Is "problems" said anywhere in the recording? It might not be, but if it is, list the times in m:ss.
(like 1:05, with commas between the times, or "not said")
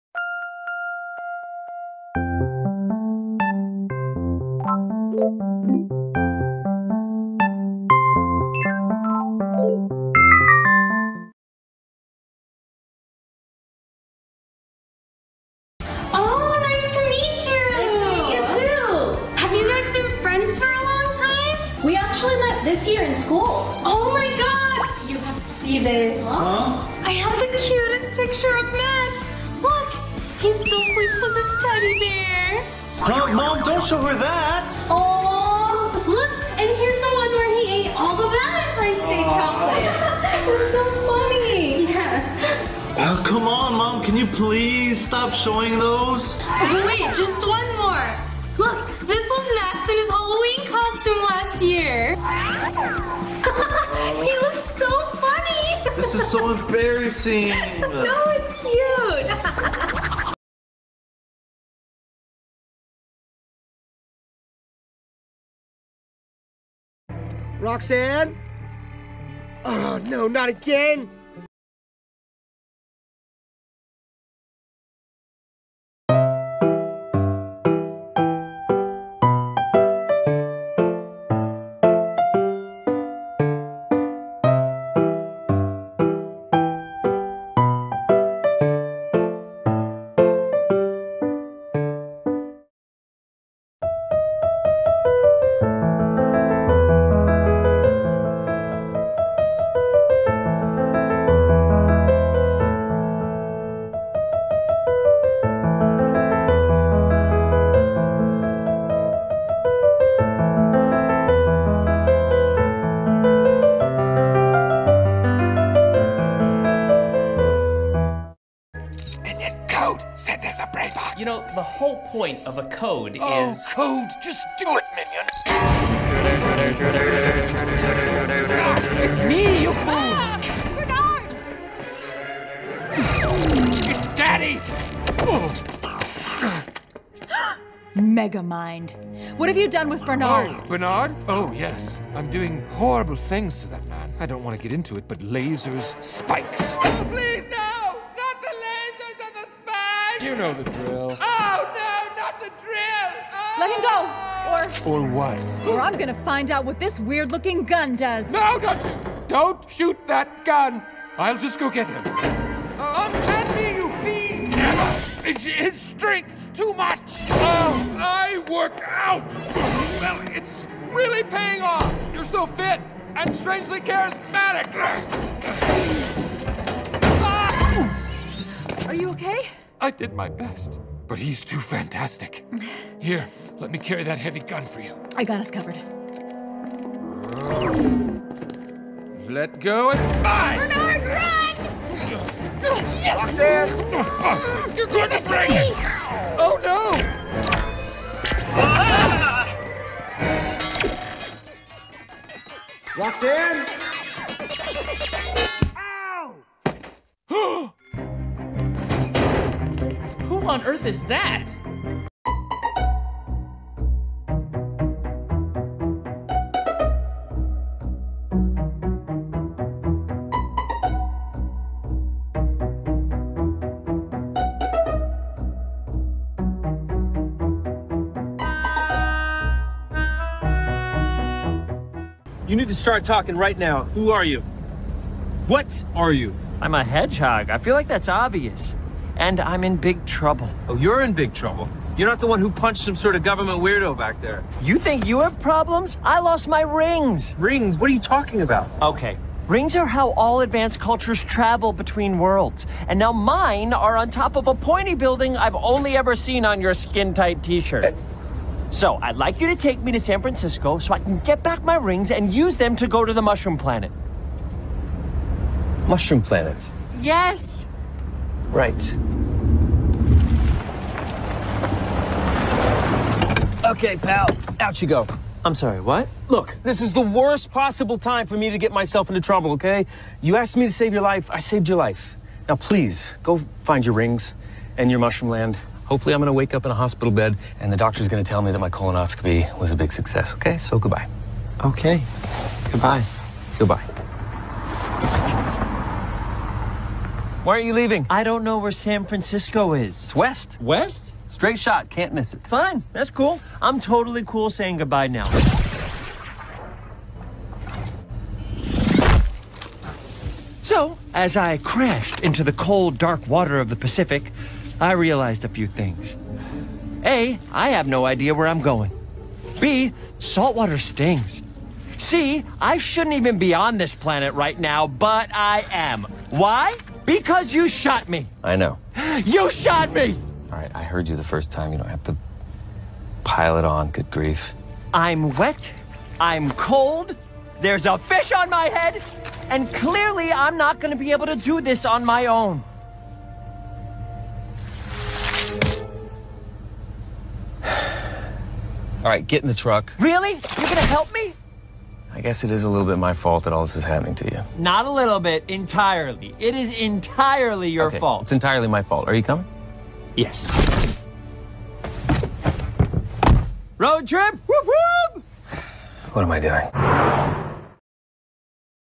4:05.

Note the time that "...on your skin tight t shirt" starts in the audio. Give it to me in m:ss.
4:16.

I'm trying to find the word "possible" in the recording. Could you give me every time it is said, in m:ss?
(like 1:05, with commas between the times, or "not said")
4:37.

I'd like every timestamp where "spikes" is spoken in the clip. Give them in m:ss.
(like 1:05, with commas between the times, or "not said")
2:26.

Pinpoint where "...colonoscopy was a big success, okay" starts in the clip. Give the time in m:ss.
4:48.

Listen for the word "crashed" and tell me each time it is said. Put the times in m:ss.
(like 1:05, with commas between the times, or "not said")
5:11.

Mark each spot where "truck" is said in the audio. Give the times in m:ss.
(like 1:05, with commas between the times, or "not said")
5:49.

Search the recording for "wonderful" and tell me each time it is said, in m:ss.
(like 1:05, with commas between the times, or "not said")
not said.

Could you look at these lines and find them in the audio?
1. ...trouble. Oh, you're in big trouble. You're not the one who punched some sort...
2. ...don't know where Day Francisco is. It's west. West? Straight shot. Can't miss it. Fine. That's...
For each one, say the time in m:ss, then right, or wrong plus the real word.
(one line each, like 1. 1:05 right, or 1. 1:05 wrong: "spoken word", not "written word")
1. 4:00 right
2. 4:58 wrong: "San", not "Day".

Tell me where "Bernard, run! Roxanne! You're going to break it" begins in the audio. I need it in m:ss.
3:10.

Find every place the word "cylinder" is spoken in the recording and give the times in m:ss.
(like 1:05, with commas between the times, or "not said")
not said.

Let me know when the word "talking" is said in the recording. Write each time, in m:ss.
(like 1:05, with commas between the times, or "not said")
3:53, 4:07.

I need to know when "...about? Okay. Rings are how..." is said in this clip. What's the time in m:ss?
4:08.